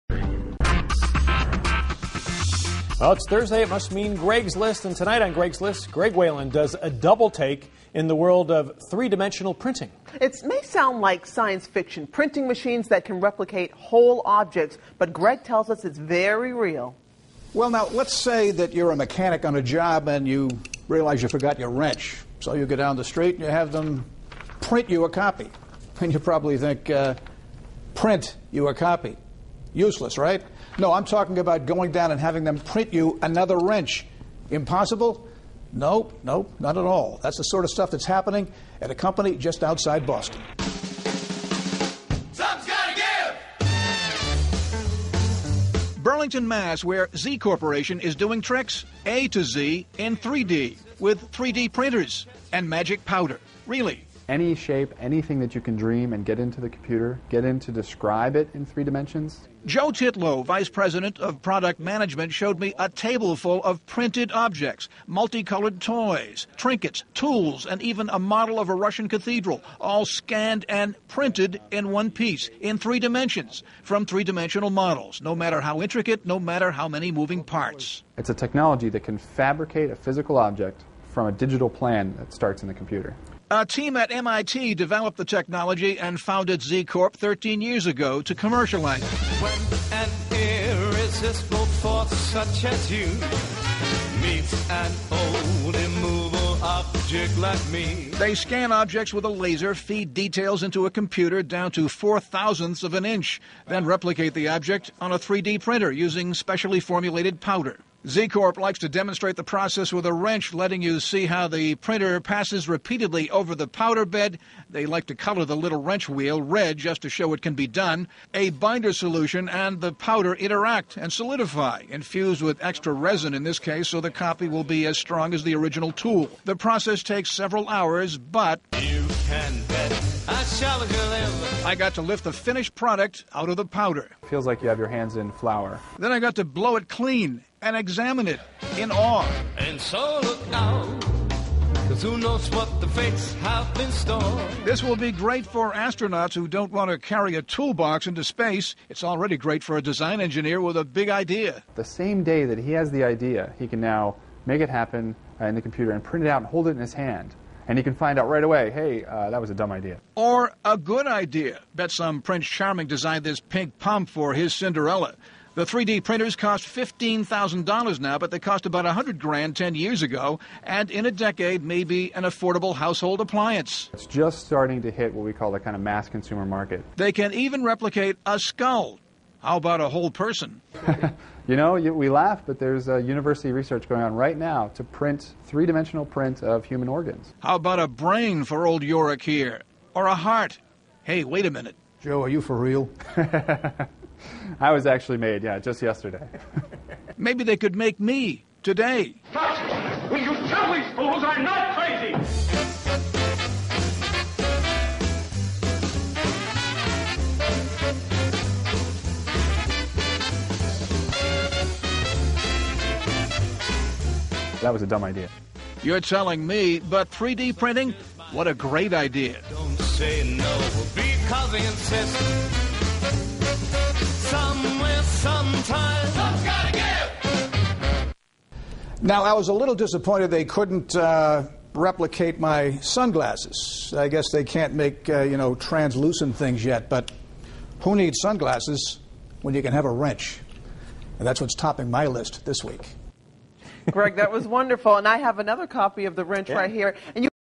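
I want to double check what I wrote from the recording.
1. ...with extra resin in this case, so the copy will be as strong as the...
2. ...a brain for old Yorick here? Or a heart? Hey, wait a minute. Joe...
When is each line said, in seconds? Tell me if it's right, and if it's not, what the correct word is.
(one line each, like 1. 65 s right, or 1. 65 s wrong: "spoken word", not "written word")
1. 122 s right
2. 187 s right.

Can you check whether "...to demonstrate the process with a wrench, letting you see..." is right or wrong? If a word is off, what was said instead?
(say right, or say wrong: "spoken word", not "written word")
right.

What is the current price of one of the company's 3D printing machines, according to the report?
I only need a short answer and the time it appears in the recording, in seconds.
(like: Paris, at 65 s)
$15,000, at 166 s.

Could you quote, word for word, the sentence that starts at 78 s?
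It's a technology that can fabricate a physical object from a digital plan that starts in the computer.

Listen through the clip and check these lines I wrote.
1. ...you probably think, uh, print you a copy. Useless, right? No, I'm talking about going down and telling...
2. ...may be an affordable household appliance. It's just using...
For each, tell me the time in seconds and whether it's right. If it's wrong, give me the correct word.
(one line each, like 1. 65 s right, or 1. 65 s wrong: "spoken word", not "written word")
1. 26 s wrong: "having", not "telling"
2. 171 s wrong: "starting", not "using".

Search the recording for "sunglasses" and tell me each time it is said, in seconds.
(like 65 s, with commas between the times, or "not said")
232 s, 238 s.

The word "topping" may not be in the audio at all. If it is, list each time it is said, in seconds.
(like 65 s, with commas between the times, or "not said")
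241 s.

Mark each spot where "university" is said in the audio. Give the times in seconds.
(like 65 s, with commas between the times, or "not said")
182 s.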